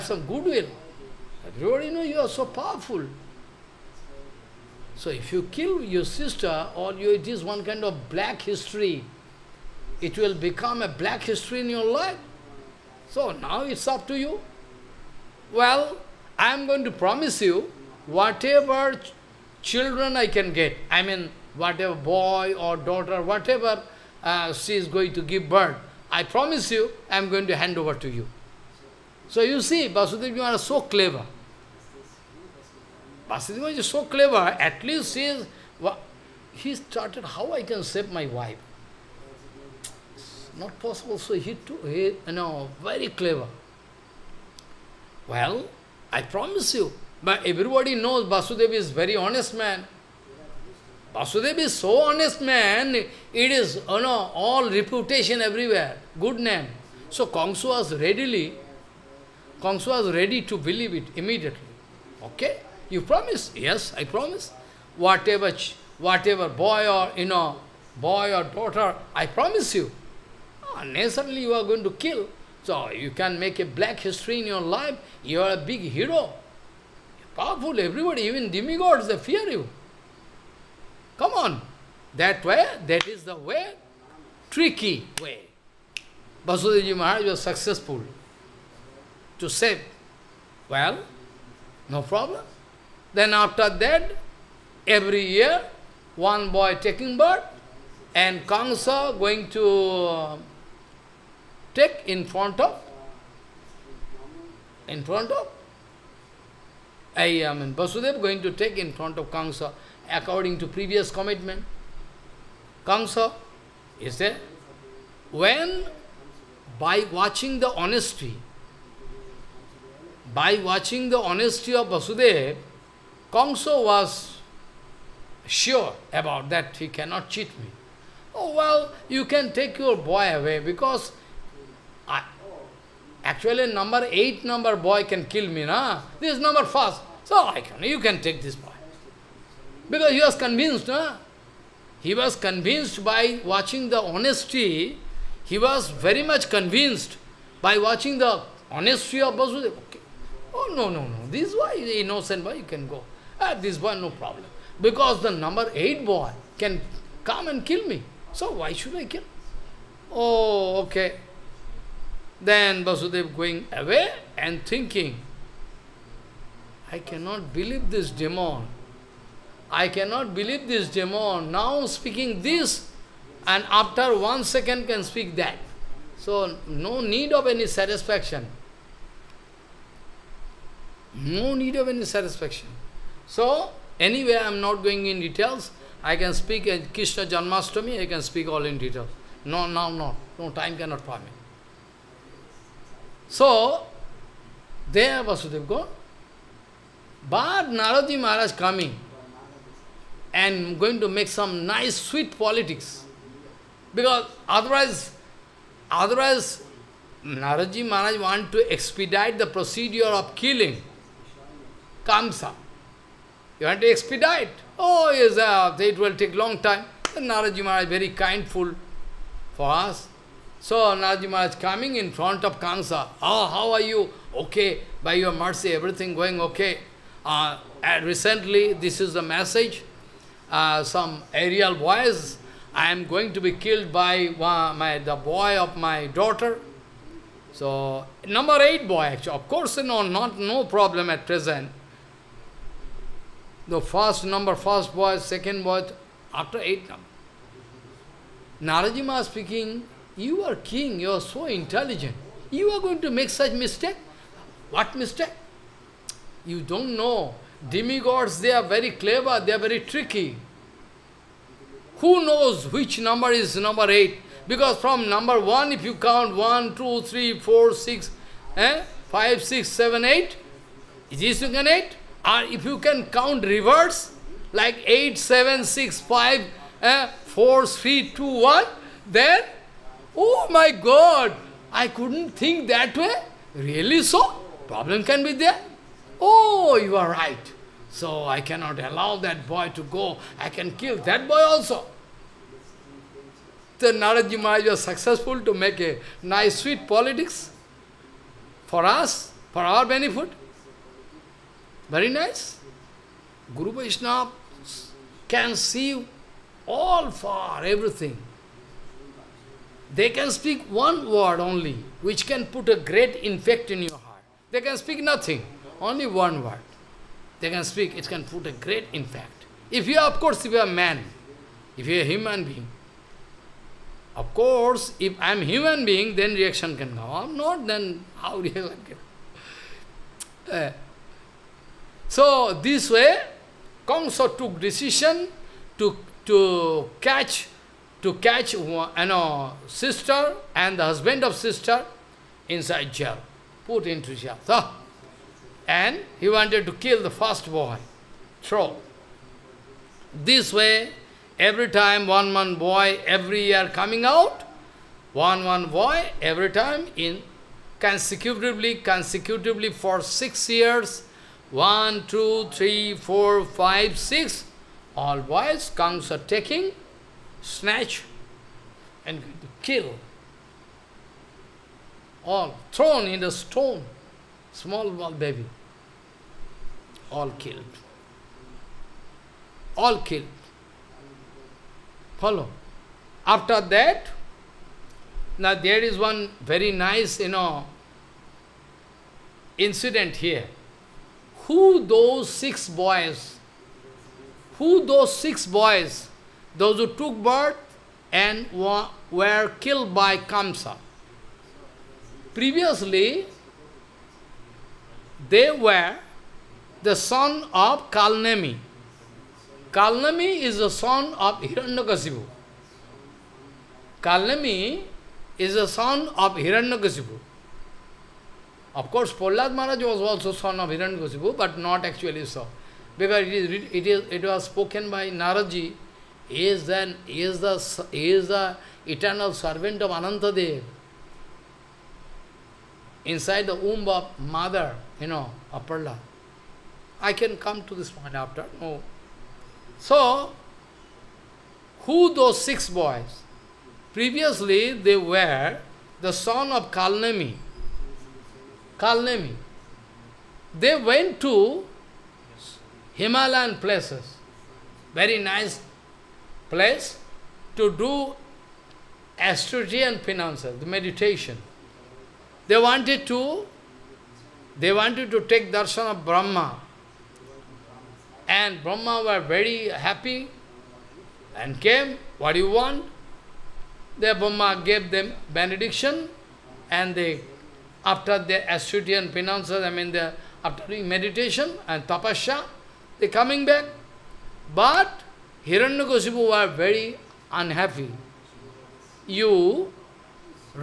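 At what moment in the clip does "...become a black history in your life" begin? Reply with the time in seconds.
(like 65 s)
10 s.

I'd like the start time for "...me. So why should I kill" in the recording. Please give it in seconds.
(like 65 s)
157 s.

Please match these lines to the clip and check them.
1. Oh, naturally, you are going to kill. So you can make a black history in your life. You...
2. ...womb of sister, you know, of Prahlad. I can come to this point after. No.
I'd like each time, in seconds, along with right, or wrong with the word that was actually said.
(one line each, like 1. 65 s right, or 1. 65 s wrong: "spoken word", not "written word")
1. 70 s right
2. 433 s wrong: "mother", not "sister".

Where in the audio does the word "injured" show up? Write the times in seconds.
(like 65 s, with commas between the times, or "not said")
not said.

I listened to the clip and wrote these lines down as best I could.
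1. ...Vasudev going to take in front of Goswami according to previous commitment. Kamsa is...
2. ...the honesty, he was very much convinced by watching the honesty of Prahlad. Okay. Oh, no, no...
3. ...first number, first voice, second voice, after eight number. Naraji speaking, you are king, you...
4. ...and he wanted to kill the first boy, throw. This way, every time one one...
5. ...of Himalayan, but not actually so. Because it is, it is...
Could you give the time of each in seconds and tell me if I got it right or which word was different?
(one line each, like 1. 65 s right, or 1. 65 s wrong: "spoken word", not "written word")
1. 107 s wrong: "Kamsa", not "Goswami"
2. 143 s wrong: "Vasudeva", not "Prahlad"
3. 243 s right
4. 345 s right
5. 420 s wrong: "Goswami", not "Himalayan".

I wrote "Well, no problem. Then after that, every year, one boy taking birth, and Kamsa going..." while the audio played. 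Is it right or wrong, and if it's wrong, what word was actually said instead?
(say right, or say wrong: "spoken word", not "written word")
right.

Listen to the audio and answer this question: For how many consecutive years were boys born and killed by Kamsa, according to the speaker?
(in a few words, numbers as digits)
6.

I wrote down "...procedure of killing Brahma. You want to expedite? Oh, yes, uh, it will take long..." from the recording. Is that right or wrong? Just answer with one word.
wrong.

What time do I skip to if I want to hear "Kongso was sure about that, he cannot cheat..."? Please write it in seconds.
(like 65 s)
123 s.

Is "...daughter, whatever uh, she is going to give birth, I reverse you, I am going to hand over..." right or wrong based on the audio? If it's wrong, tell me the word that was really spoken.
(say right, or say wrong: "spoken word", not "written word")
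wrong: "promise", not "reverse".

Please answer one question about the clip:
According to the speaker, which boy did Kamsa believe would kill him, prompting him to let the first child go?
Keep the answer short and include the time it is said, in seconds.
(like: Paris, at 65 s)
Number 8, at 133 s.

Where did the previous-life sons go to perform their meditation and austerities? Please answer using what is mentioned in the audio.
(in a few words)
Himalayan places.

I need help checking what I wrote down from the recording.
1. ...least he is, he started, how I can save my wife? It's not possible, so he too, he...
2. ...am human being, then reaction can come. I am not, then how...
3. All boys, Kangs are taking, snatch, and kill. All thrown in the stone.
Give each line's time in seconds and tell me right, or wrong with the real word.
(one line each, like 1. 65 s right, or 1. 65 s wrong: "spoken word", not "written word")
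1. 34 s right
2. 325 s right
3. 364 s right.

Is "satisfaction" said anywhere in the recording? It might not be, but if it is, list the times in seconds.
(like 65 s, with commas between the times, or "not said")
177 s, 182 s.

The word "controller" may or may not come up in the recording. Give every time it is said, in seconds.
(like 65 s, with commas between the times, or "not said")
not said.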